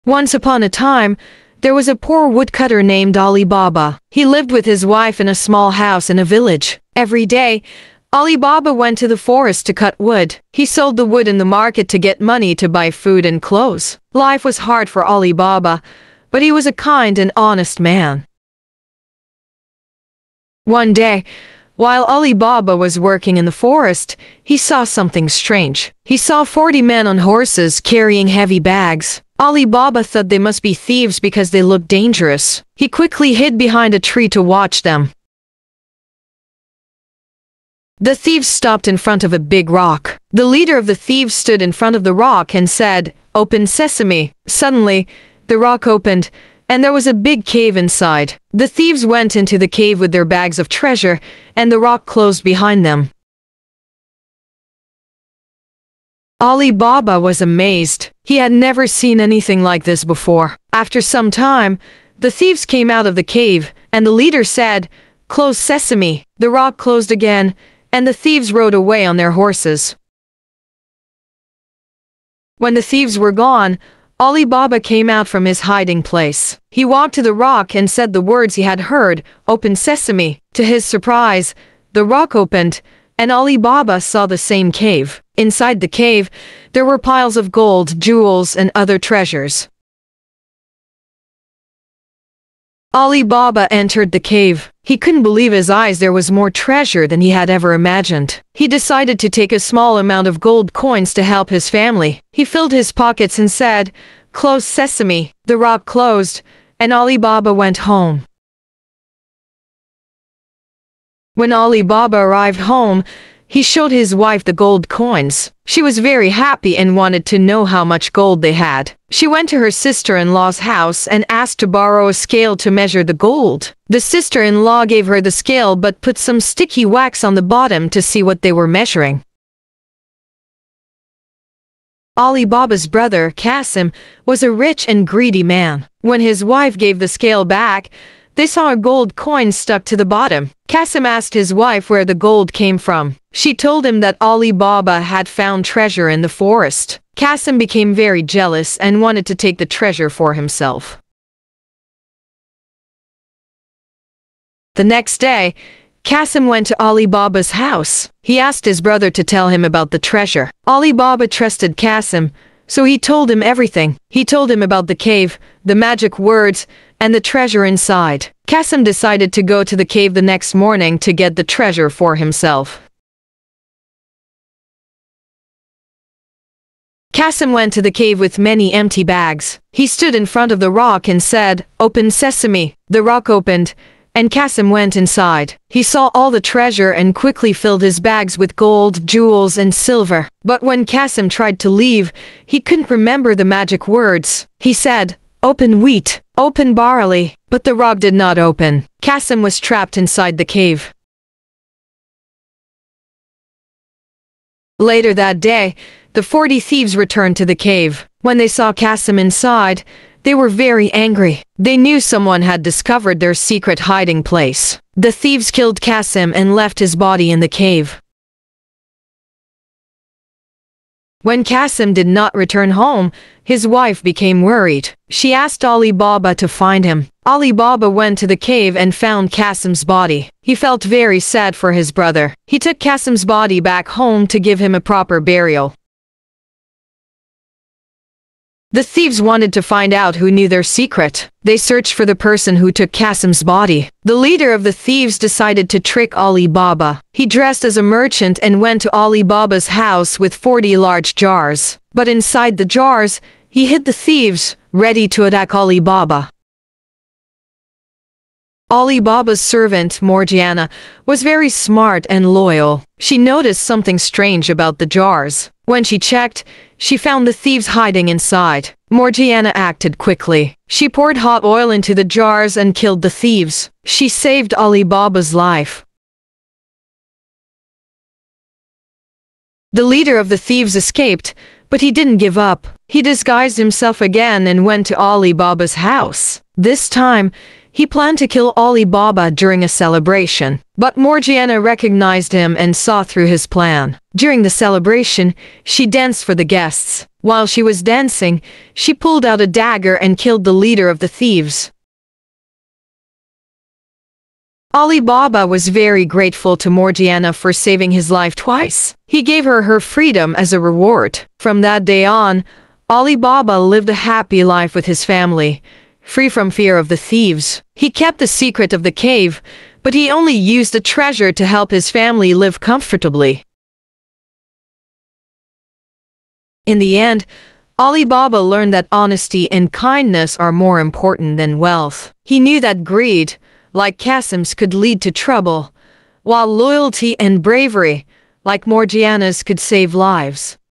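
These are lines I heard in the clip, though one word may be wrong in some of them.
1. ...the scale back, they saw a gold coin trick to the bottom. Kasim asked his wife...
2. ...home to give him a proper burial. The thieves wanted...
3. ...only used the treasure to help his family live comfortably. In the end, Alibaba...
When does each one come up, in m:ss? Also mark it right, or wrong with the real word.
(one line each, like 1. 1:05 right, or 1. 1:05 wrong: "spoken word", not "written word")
1. 2:16 wrong: "stuck", not "trick"
2. 3:53 right
3. 5:20 right.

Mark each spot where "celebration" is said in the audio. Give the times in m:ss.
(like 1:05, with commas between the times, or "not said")
4:49, 4:54.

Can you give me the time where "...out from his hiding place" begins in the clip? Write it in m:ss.
1:15.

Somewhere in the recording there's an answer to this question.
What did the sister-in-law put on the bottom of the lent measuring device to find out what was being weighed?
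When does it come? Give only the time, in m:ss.
2:06.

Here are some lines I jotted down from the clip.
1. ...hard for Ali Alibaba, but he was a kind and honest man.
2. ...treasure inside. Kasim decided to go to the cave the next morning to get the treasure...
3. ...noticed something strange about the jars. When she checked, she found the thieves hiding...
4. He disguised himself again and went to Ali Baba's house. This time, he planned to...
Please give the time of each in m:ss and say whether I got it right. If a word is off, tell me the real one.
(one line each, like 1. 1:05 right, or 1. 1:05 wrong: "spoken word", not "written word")
1. 0:14 wrong: "Baba", not "Alibaba"
2. 2:47 right
3. 4:23 right
4. 4:42 right.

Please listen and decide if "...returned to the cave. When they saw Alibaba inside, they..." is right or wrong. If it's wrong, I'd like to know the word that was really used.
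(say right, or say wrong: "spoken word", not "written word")
wrong: "Kasim", not "Alibaba".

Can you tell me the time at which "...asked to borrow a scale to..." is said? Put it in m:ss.
2:01.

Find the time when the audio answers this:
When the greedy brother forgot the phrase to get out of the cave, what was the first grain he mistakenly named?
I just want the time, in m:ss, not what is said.
3:15.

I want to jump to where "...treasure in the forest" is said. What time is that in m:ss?
2:25.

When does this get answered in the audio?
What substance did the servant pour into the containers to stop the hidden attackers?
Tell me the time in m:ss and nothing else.
4:31.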